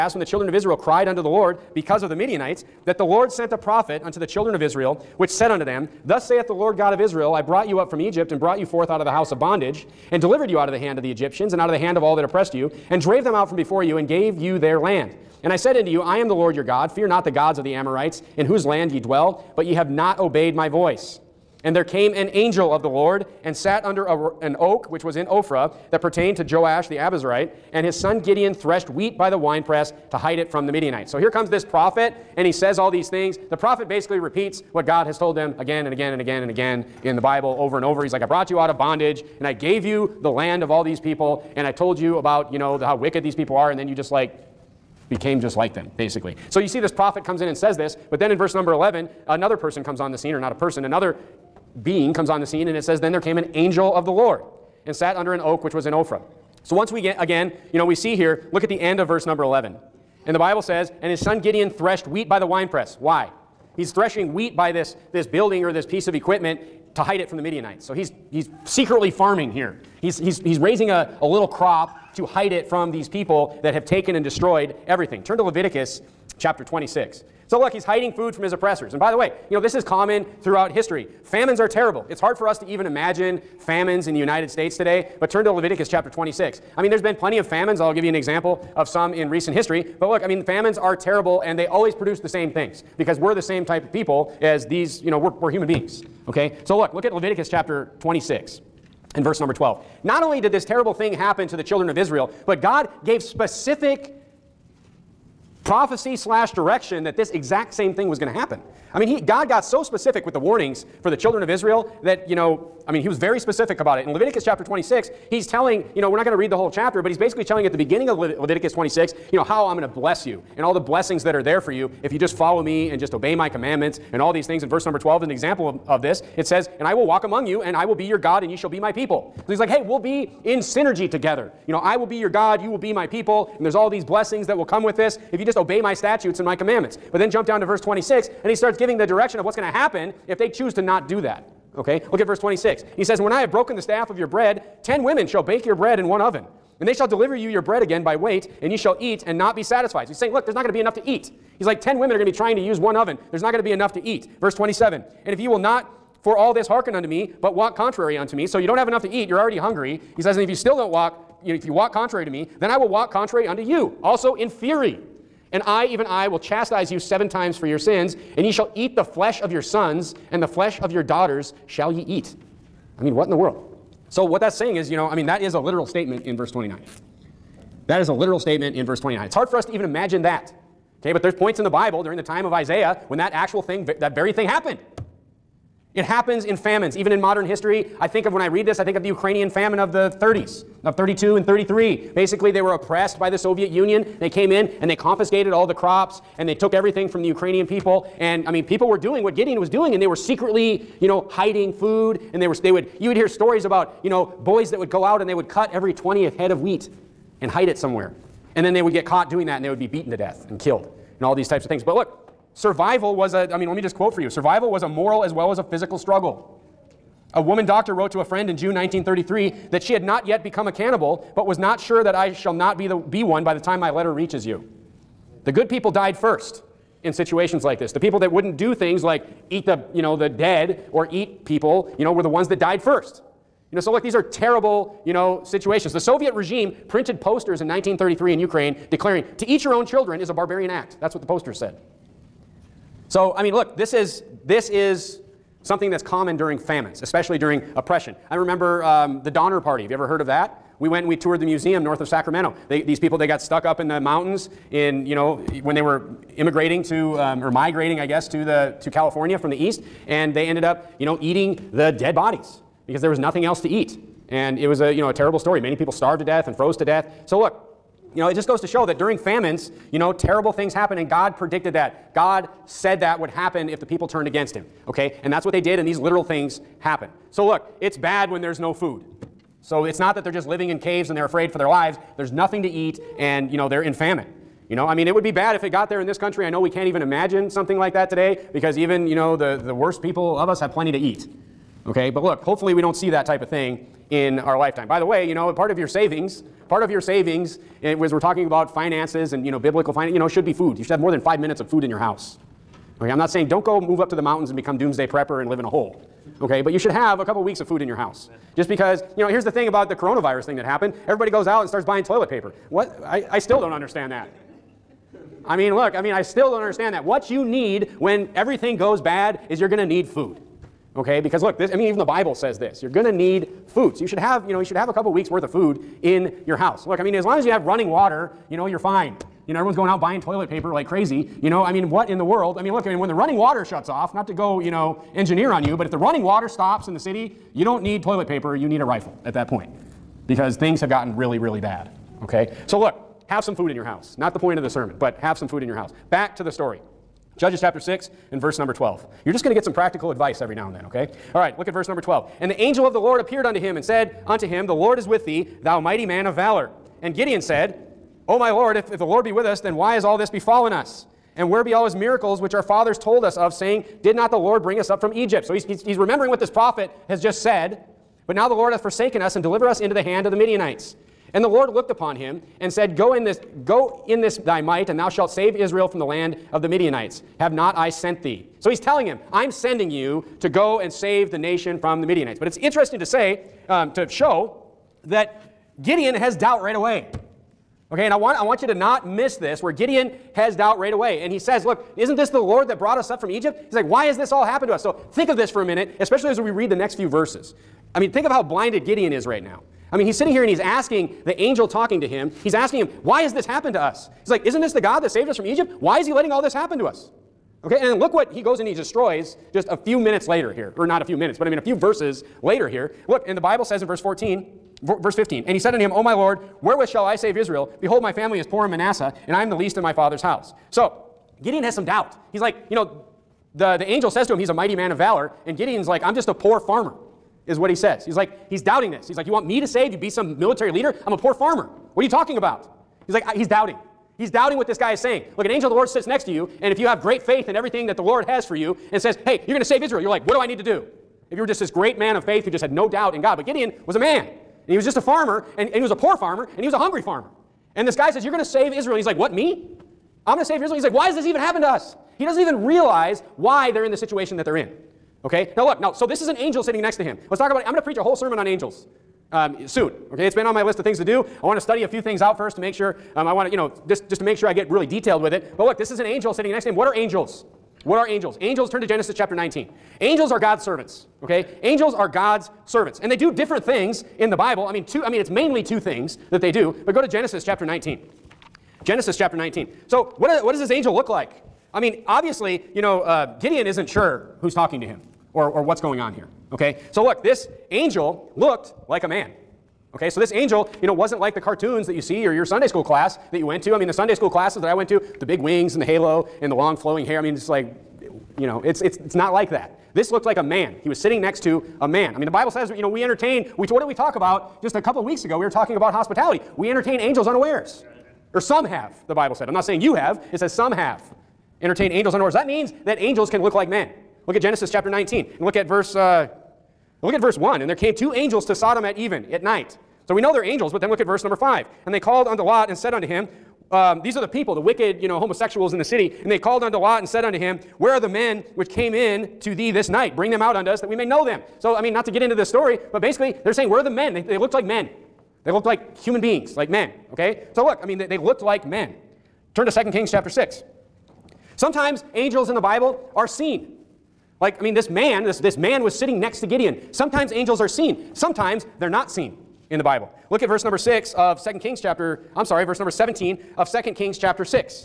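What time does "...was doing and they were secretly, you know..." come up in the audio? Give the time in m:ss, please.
3:19.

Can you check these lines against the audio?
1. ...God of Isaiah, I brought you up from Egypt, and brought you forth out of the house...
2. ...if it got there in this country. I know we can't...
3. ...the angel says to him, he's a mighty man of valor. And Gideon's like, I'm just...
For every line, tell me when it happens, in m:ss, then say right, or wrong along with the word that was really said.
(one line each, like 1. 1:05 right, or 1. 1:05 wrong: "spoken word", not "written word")
1. 0:06 wrong: "Israel", not "Isaiah"
2. 4:45 right
3. 7:03 right.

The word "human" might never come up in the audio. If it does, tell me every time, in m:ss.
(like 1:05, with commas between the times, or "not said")
1:35, 8:55.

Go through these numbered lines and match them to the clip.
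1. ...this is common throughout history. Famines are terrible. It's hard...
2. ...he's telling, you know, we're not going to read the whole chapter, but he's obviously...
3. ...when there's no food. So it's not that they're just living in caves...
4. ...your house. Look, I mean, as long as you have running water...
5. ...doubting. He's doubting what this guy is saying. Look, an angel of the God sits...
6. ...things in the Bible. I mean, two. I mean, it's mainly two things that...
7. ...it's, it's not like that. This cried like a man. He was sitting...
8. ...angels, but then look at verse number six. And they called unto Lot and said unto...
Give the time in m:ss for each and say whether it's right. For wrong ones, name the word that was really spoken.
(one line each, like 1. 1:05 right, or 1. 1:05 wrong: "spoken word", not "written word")
1. 1:19 right
2. 1:55 wrong: "basically", not "obviously"
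3. 4:38 right
4. 5:26 right
5. 7:13 wrong: "Lord", not "God"
6. 7:53 right
7. 8:18 wrong: "looked", not "cried"
8. 8:40 wrong: "five", not "six".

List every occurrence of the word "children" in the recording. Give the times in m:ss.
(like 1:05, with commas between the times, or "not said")
0:00, 0:04, 1:41, 1:51, 3:59.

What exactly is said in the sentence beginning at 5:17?
What you need when everything goes bad is you're going to need food.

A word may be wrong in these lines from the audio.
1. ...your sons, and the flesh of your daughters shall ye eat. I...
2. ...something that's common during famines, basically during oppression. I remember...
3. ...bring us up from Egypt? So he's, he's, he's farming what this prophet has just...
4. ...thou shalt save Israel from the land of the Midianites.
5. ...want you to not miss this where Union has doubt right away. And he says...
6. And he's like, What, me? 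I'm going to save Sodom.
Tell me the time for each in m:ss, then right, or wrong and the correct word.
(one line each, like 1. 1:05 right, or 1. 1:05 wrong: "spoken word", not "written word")
1. 2:49 right
2. 4:05 wrong: "especially", not "basically"
3. 6:04 wrong: "remembering", not "farming"
4. 6:14 right
5. 6:28 wrong: "Gideon", not "Union"
6. 7:28 wrong: "Israel", not "Sodom".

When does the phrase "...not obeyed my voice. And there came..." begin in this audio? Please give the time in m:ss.
0:19.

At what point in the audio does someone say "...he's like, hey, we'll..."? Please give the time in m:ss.
2:09.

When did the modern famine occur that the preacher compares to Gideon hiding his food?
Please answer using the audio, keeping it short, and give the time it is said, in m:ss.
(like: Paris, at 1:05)
32 and 33, at 3:10.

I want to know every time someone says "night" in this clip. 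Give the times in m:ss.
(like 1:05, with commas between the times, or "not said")
8:39, 8:49.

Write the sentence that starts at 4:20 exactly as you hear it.
And they ended up, you know, eating the dead bodies because there was nothing else to eat.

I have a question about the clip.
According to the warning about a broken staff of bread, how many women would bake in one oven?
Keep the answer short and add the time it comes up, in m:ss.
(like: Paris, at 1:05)
10, at 2:24.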